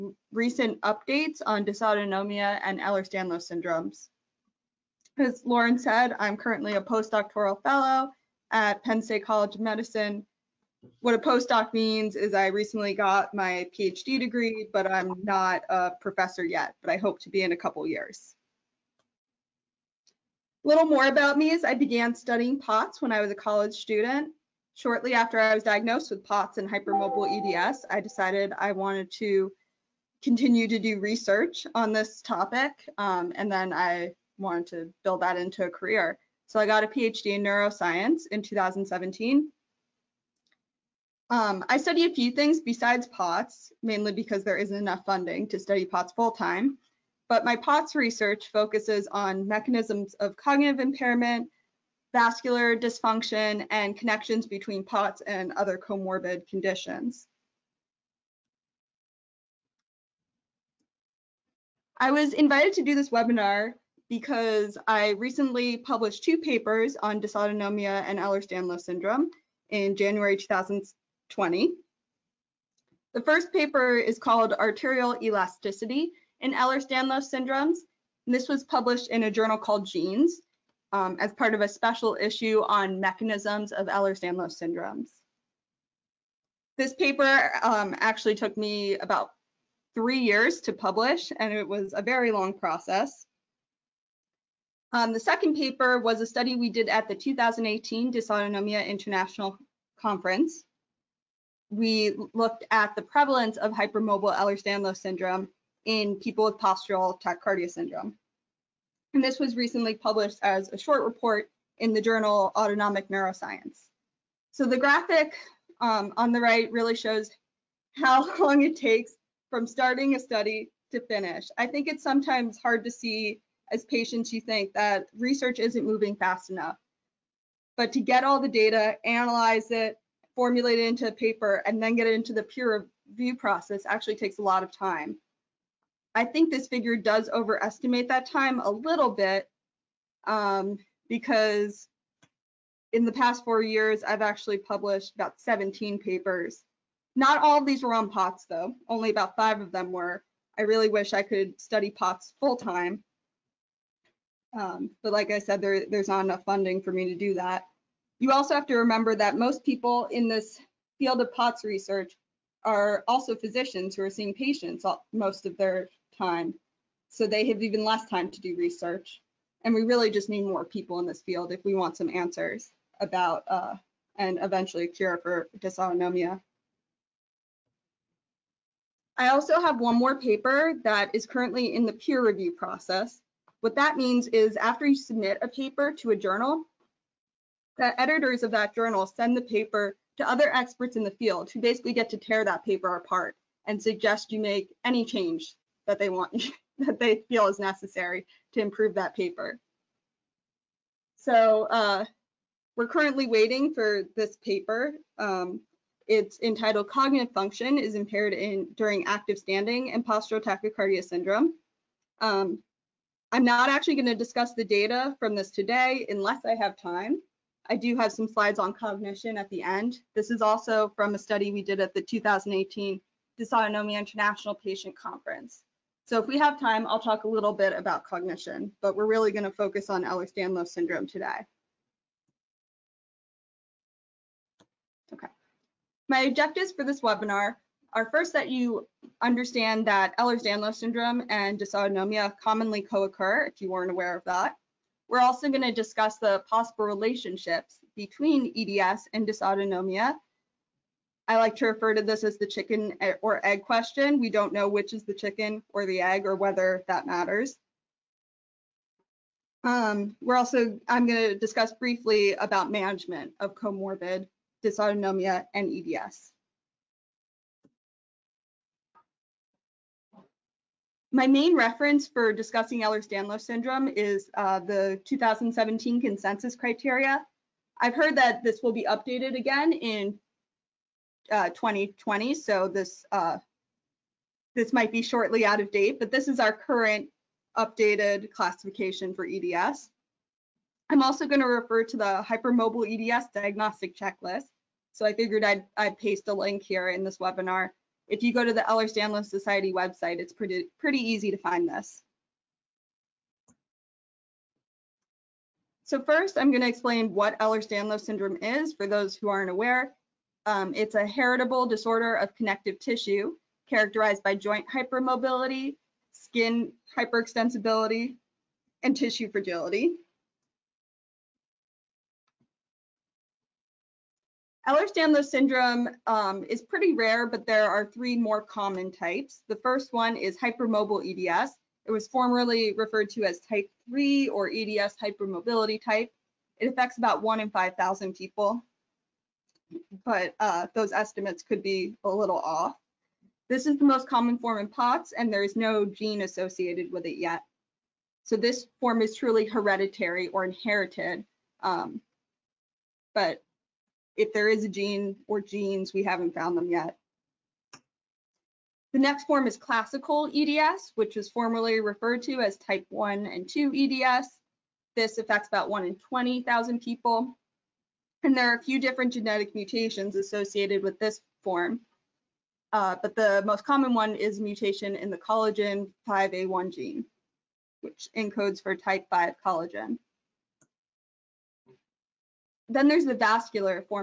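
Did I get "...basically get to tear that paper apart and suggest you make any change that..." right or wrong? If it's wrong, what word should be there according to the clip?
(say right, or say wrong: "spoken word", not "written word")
right.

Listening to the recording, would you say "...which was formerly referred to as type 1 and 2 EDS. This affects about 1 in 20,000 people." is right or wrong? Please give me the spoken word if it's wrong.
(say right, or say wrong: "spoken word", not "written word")
right.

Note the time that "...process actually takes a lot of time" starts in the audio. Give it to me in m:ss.
2:13.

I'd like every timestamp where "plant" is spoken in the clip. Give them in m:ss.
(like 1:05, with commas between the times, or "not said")
not said.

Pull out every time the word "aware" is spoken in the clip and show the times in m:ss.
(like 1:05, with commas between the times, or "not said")
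4:03, 5:09.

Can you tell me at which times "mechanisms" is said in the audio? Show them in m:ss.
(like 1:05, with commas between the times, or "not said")
0:49, 1:22.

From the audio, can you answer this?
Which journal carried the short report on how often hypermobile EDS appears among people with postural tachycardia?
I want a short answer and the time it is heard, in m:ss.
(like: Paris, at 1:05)
Autonomic Neuroscience, at 1:52.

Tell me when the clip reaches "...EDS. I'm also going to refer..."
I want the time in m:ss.
4:49.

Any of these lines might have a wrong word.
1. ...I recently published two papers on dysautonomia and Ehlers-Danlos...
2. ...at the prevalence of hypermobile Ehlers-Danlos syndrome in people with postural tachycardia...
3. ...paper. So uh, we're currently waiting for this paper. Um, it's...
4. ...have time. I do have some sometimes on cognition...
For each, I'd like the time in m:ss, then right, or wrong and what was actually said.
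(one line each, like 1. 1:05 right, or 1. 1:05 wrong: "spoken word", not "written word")
1. 1:04 right
2. 1:42 right
3. 3:19 right
4. 3:36 wrong: "slides", not "sometimes".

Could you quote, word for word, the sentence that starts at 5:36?
It affects about 1 in 5,000 people but uh, those estimates could be a little off.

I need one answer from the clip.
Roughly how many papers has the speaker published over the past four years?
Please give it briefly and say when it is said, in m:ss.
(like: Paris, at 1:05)
17, at 2:25.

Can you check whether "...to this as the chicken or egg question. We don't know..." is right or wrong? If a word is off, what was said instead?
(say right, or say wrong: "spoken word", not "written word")
right.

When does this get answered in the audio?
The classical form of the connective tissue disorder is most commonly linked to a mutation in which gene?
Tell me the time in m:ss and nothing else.
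6:15.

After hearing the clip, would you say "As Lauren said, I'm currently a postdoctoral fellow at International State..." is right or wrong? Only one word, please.
wrong.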